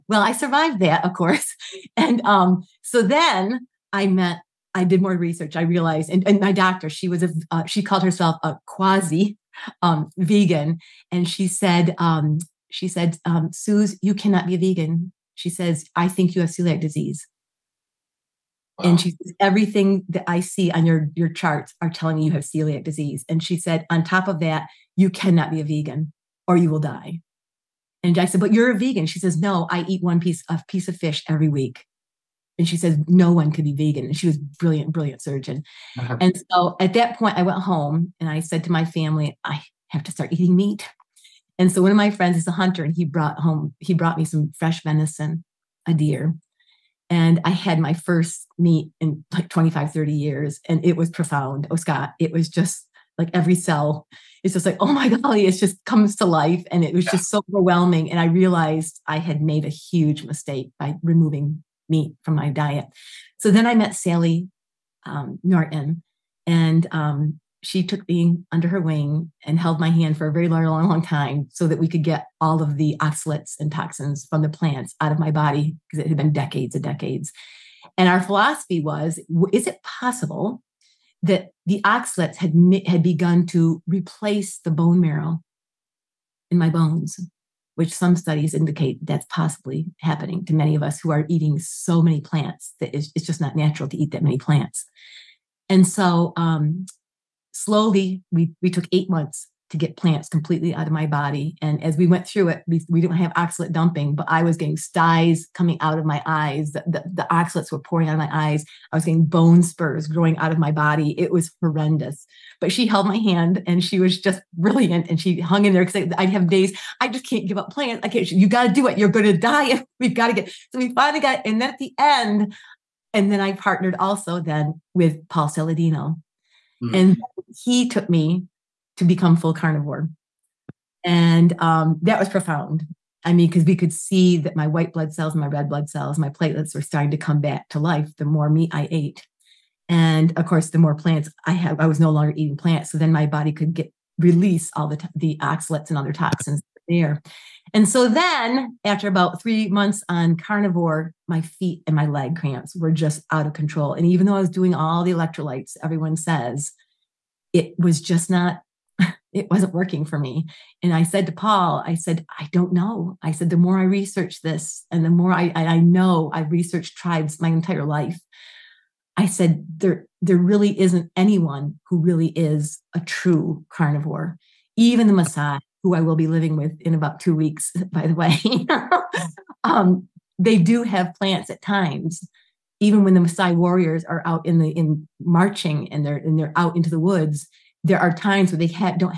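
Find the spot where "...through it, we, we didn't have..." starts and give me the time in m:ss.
1:42.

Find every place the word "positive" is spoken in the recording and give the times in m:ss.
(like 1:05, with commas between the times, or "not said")
not said.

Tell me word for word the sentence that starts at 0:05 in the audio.
I realized, and, and my doctor, she was a, uh, she called herself a quasi um, vegan.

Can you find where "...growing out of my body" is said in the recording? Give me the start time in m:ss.
1:50.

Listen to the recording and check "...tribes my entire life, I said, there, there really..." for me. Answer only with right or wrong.
right.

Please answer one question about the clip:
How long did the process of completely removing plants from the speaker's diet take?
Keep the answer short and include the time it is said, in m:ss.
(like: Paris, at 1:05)
8 months, at 1:38.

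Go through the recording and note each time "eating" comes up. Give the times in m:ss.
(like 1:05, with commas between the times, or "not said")
0:40, 1:31, 2:22.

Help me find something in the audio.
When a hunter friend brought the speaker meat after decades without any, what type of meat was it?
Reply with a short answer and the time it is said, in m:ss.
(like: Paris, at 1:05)
Venison, at 0:44.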